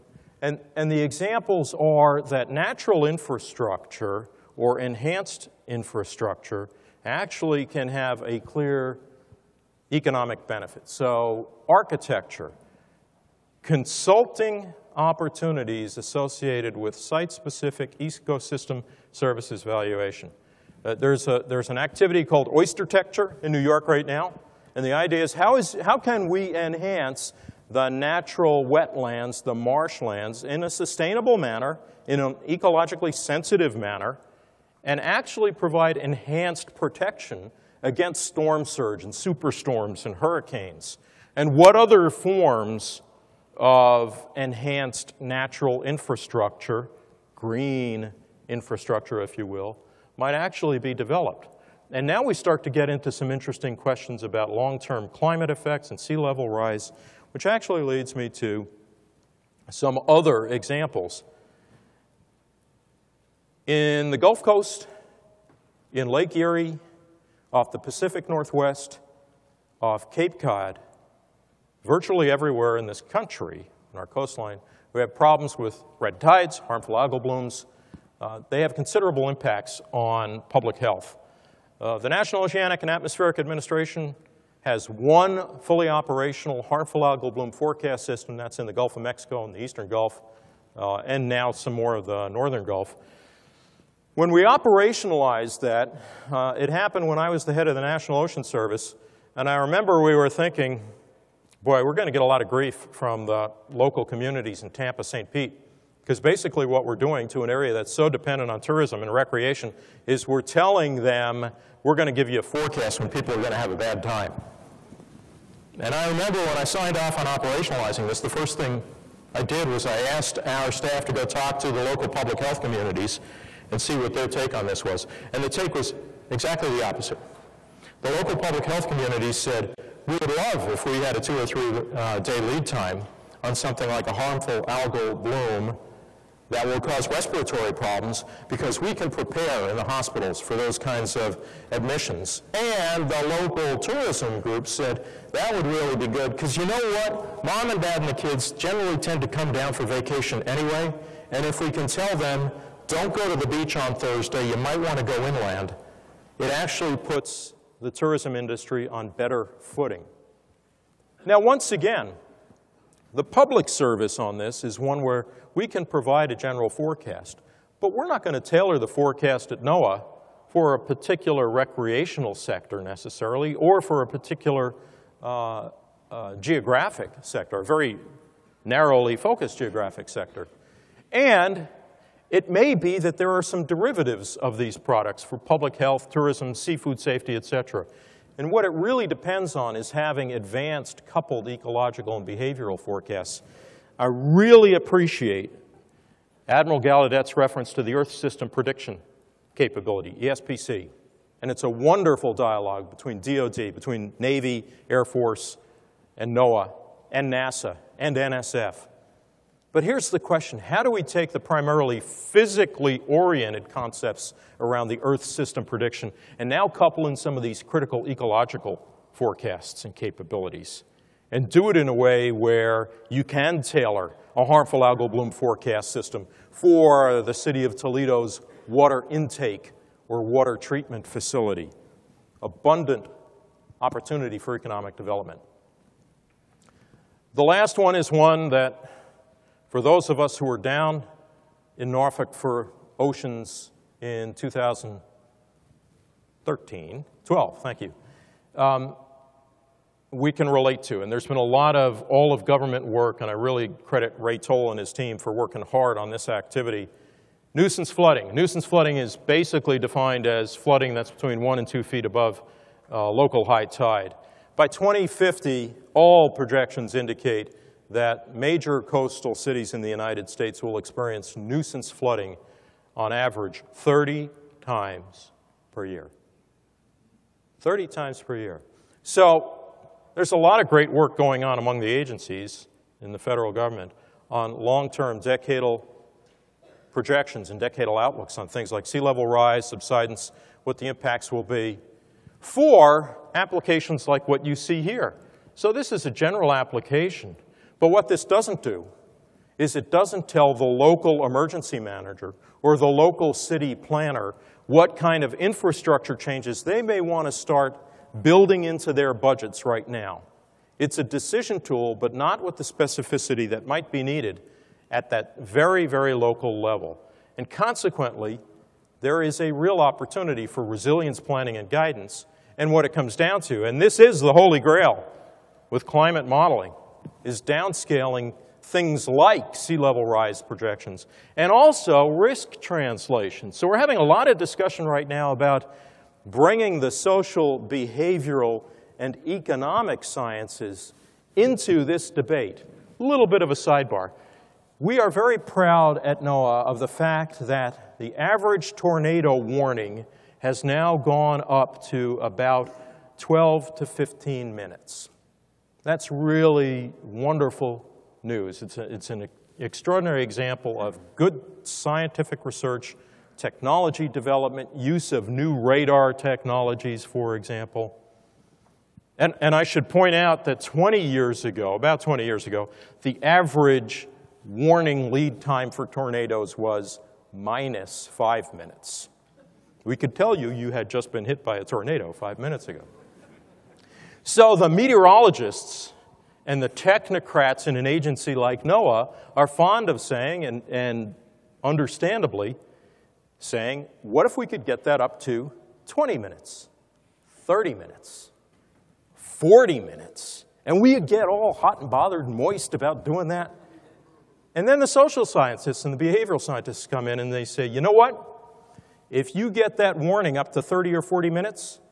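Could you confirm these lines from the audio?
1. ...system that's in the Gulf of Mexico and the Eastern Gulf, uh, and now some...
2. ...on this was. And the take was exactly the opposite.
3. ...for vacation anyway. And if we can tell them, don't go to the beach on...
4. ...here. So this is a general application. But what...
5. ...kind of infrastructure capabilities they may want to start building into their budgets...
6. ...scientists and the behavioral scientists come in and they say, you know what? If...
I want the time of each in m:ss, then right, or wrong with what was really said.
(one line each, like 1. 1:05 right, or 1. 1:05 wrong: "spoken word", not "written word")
1. 1:28 right
2. 2:04 right
3. 2:29 right
4. 4:54 right
5. 5:04 wrong: "changes", not "capabilities"
6. 6:45 right.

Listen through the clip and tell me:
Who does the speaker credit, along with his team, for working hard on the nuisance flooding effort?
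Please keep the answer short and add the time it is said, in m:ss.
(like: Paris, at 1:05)
Ray Toll, at 4:14.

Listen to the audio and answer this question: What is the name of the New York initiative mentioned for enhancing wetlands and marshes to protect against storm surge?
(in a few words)
Oyster-tecture.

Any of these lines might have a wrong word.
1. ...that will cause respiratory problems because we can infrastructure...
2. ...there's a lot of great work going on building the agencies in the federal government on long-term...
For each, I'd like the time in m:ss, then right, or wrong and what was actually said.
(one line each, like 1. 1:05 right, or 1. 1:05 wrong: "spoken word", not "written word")
1. 2:16 wrong: "prepare", not "infrastructure"
2. 4:40 wrong: "among", not "building".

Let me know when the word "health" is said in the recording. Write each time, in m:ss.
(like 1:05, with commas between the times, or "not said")
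1:20, 2:02, 2:08, 3:05.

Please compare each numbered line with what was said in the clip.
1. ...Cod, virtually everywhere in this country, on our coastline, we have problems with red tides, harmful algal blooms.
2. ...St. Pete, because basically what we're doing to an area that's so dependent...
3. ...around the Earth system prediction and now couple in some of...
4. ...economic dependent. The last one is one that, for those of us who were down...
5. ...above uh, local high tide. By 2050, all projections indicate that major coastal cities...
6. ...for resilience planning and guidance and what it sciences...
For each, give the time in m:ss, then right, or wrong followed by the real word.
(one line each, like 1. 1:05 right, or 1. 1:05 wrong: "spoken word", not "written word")
1. 1:10 right
2. 1:45 right
3. 3:34 right
4. 3:54 wrong: "development", not "dependent"
5. 4:22 right
6. 5:20 wrong: "comes", not "sciences".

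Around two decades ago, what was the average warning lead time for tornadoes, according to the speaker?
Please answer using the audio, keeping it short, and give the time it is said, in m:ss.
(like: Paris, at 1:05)
minus 5 minutes, at 6:17.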